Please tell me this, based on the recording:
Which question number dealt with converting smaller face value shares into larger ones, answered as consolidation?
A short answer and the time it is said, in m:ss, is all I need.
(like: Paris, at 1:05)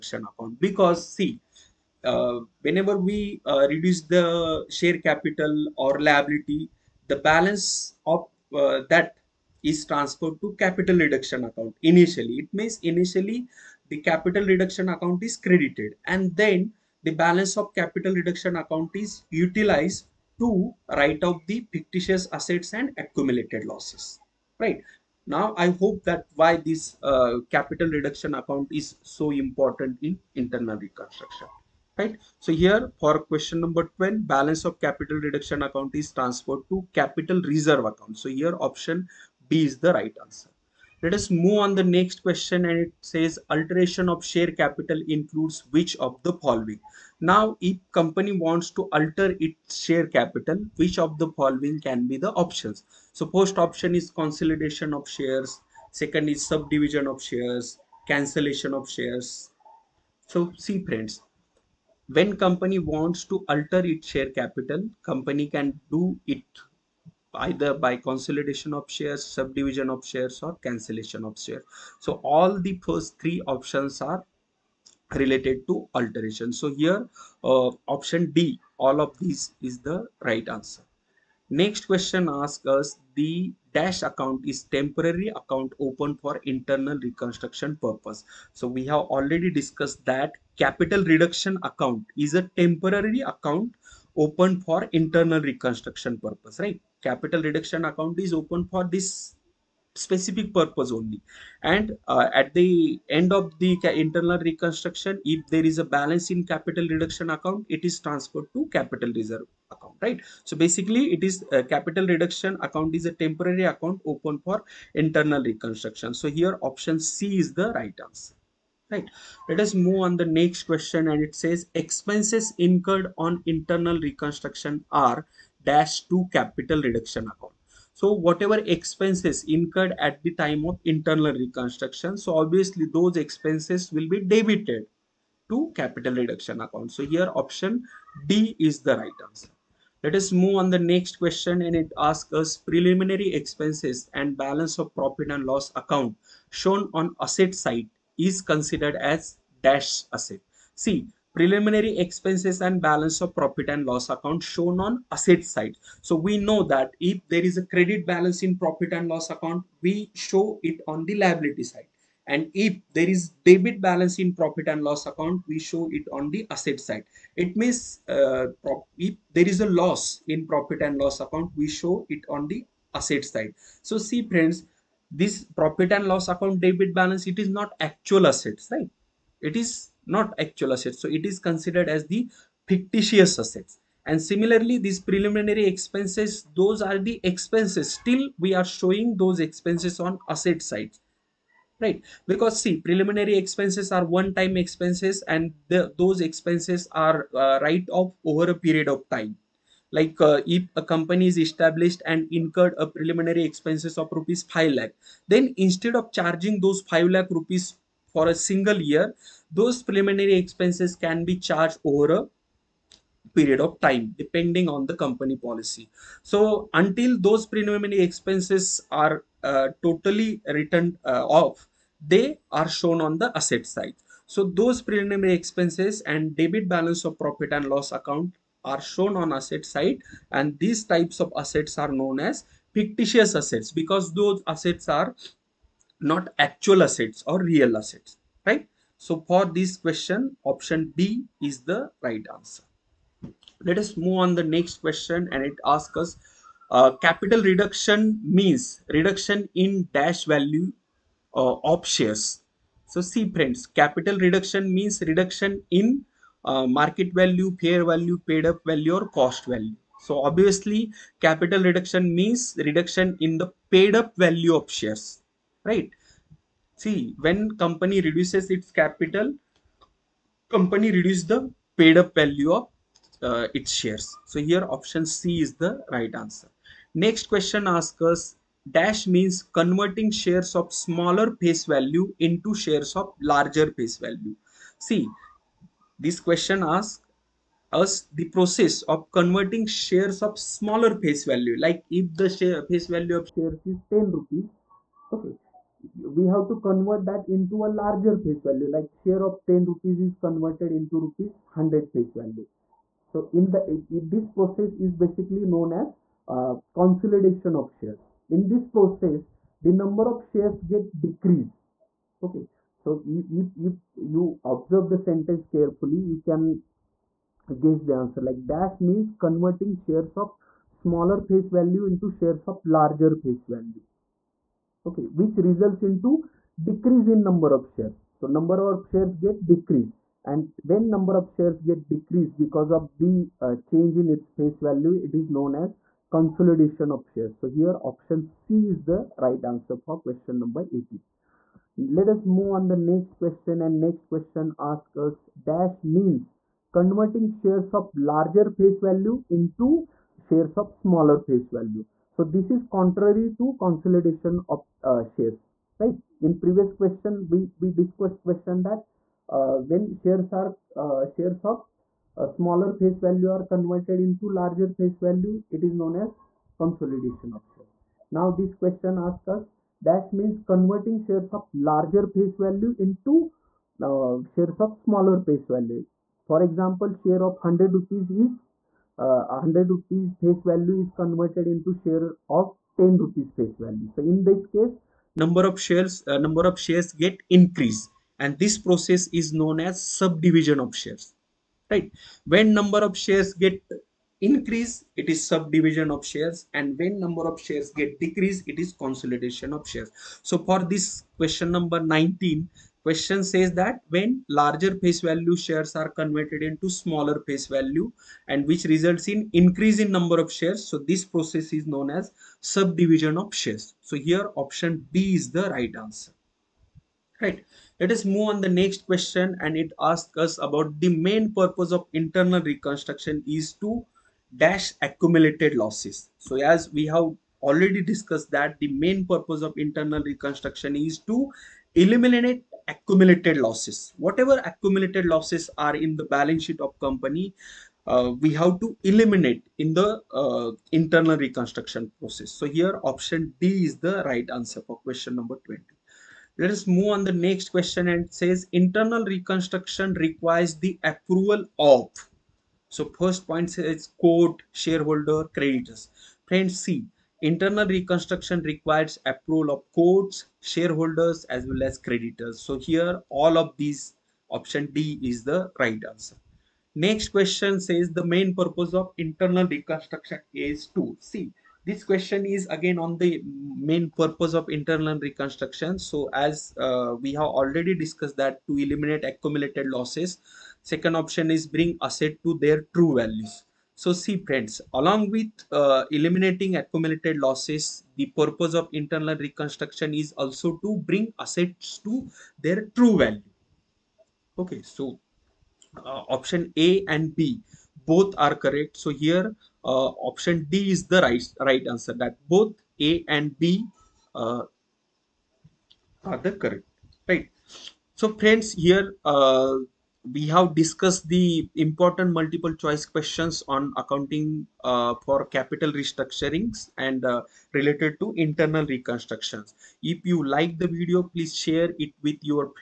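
18, at 5:40.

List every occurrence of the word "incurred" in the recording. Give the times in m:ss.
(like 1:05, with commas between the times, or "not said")
2:02, 2:09, 3:22.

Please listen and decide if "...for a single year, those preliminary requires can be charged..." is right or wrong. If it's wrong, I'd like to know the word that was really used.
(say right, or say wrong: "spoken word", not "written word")
wrong: "expenses", not "requires".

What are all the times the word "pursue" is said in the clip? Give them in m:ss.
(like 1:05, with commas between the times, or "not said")
not said.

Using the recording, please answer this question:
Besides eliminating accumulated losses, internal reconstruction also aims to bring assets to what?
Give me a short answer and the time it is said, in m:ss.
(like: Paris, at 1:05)
Their true values, at 8:02.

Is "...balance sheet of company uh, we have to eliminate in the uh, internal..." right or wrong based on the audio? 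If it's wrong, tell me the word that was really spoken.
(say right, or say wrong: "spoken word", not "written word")
right.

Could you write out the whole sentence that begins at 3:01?
So it is considered as the fictitious assets.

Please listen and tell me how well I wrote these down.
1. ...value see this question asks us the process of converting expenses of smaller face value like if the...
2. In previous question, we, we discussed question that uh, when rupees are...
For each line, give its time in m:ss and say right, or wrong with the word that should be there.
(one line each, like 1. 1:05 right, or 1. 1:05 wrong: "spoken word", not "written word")
1. 4:43 wrong: "shares", not "expenses"
2. 5:56 wrong: "shares", not "rupees".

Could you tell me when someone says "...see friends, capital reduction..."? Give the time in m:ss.
4:13.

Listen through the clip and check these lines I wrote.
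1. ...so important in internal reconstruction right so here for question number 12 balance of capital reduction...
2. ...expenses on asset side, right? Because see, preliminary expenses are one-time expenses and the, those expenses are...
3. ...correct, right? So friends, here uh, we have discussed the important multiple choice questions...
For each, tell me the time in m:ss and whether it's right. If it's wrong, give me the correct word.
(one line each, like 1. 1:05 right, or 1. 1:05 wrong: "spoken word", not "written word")
1. 0:29 right
2. 3:09 right
3. 8:26 right.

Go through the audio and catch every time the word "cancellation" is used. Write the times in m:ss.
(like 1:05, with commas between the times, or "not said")
0:58, 1:10.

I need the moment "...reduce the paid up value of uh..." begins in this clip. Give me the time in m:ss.
4:30.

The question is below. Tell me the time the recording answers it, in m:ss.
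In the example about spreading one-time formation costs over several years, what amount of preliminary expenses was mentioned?
3:24.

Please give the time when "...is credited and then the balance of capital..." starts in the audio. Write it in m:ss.
0:15.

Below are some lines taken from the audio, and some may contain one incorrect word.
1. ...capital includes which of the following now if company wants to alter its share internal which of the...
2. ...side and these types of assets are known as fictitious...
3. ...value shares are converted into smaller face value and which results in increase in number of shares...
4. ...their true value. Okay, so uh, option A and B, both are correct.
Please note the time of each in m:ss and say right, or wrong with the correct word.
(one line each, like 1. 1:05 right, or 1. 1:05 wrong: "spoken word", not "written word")
1. 0:44 wrong: "capital", not "internal"
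2. 3:49 right
3. 6:45 right
4. 8:12 right.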